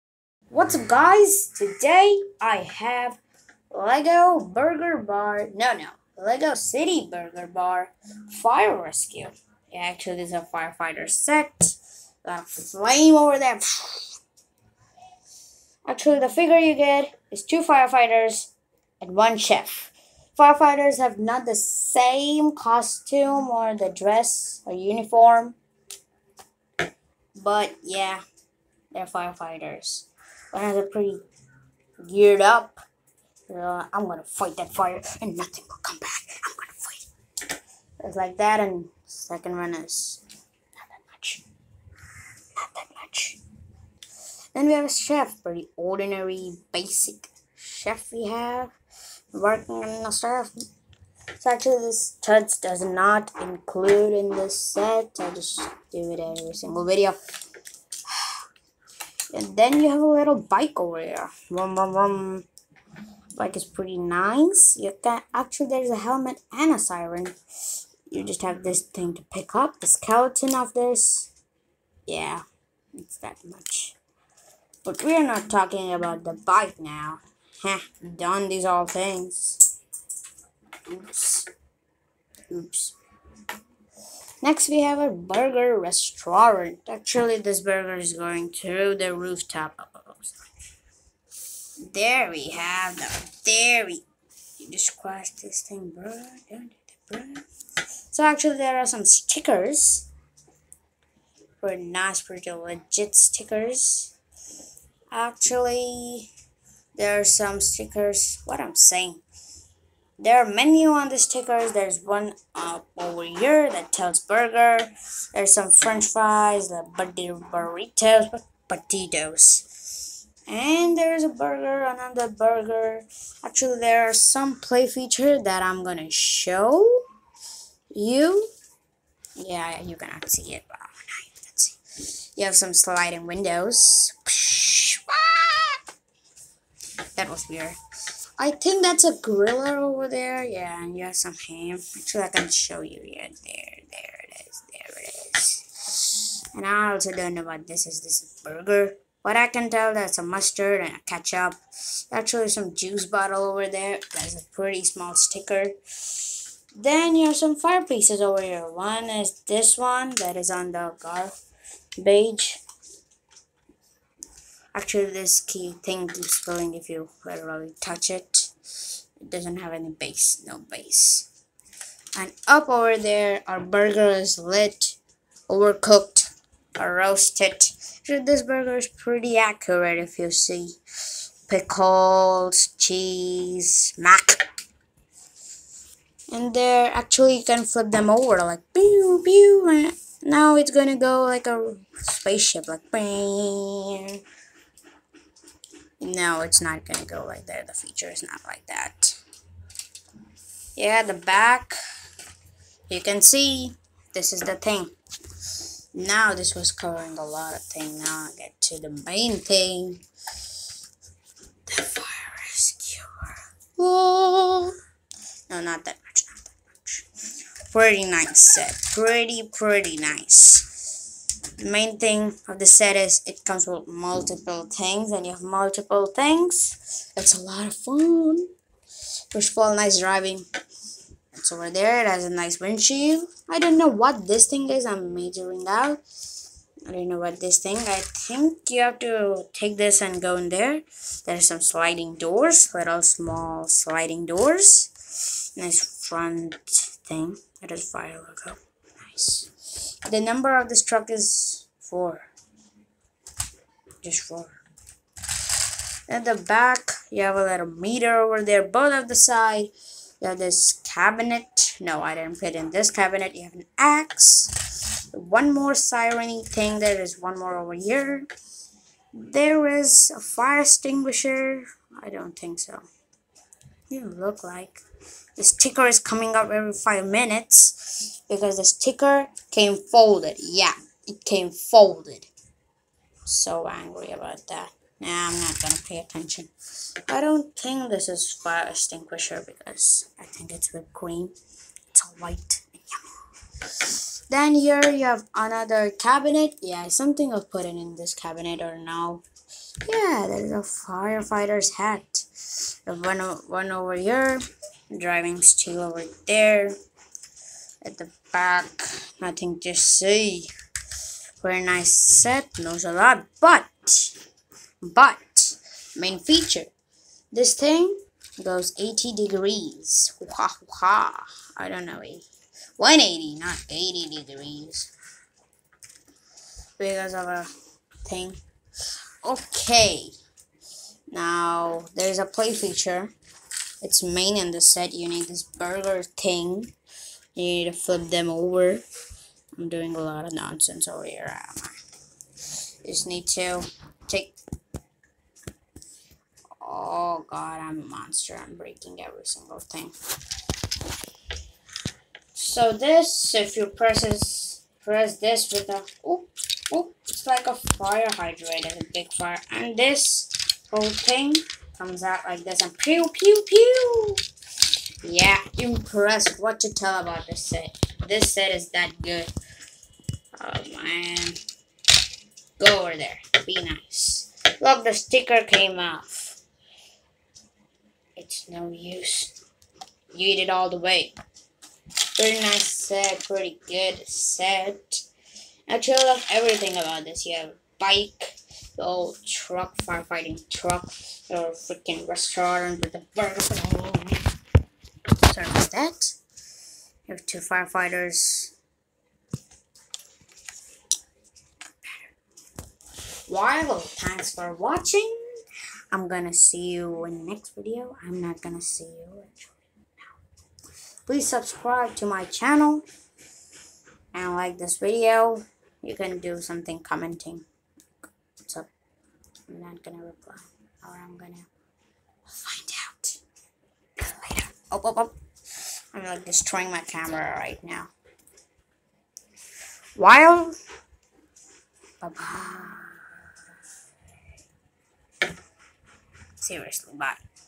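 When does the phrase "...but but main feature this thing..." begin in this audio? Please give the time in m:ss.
5:13.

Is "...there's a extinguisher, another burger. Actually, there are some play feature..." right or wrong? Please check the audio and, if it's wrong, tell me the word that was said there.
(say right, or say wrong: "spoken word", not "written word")
wrong: "burger", not "extinguisher".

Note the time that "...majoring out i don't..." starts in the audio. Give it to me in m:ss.
3:55.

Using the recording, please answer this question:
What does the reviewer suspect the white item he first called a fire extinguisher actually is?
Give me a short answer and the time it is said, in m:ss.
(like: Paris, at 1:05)
Whipped cream, at 4:50.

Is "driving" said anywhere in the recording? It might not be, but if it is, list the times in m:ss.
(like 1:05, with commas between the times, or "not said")
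3:49, 5:04.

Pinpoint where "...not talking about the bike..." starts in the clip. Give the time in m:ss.
1:15.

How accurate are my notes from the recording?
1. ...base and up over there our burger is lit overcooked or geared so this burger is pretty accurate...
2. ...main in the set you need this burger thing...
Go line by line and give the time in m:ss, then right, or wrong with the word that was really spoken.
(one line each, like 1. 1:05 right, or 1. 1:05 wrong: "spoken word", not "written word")
1. 2:50 wrong: "roasted", not "geared"
2. 5:34 right.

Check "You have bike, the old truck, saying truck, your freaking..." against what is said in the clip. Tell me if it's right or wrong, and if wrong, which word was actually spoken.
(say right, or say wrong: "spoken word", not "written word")
wrong: "firefighting", not "saying".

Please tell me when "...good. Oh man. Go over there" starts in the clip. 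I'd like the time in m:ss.
6:09.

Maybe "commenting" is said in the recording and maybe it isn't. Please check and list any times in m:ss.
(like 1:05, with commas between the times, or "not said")
6:56.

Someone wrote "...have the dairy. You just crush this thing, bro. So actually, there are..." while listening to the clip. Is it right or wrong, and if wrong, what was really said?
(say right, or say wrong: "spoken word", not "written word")
right.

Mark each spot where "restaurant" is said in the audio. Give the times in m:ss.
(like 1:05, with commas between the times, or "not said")
1:25, 6:32.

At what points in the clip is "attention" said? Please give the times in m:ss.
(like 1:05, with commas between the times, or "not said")
4:45.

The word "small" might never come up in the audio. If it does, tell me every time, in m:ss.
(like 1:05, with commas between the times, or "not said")
2:34, 4:03.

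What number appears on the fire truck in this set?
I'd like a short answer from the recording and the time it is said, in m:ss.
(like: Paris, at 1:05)
4, at 4:10.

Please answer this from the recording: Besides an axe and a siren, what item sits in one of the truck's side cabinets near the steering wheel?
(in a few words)
Firefighter's hat.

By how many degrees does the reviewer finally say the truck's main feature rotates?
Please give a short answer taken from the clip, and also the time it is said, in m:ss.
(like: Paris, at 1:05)
180, at 5:22.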